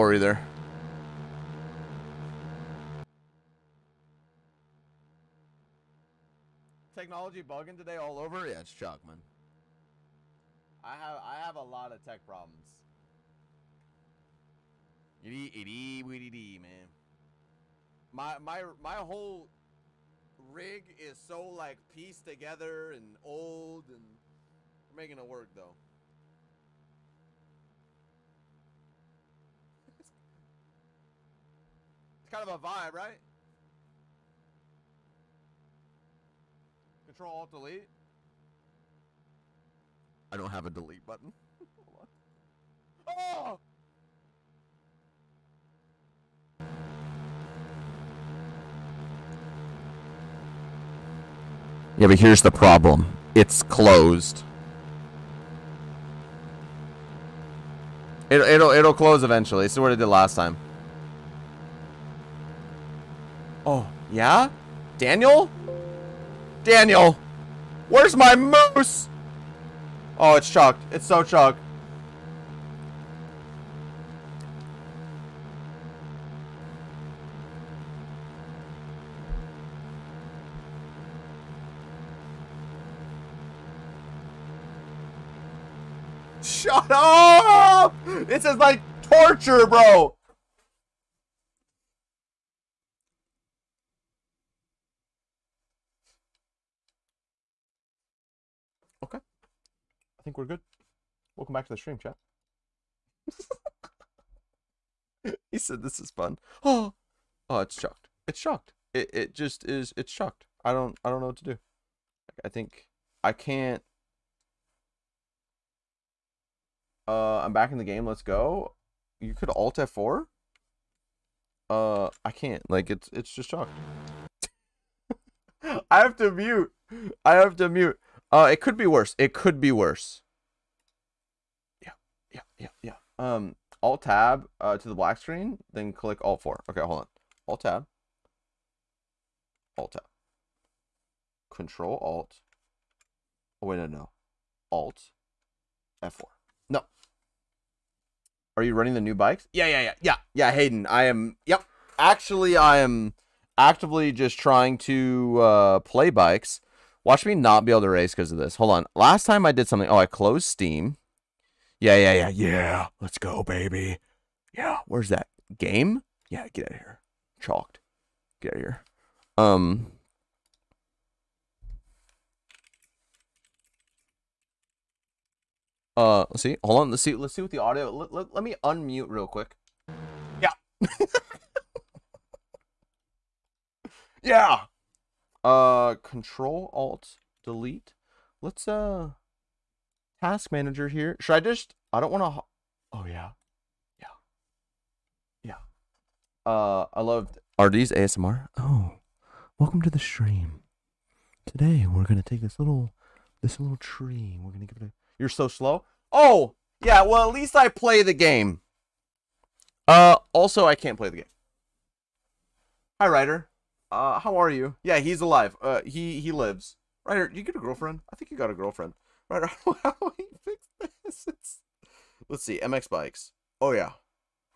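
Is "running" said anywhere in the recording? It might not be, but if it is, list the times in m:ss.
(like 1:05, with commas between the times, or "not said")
2:28.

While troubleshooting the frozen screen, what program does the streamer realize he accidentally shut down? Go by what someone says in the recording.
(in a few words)
Steam.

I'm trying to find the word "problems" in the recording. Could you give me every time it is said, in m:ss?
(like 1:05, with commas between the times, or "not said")
0:12, 0:52.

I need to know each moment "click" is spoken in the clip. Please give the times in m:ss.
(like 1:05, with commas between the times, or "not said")
2:15.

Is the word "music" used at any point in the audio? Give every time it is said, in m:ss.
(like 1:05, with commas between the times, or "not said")
not said.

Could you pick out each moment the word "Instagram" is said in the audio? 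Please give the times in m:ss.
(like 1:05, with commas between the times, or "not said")
not said.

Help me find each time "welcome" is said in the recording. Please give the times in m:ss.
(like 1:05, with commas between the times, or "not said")
1:41, 3:19.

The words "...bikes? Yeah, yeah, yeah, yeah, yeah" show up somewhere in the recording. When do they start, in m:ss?
2:29.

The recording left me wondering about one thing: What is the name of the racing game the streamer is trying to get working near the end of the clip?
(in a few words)
MX Bikes.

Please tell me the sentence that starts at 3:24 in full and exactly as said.
We're gonna give it a you're so slow.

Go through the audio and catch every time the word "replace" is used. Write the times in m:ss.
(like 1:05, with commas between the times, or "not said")
not said.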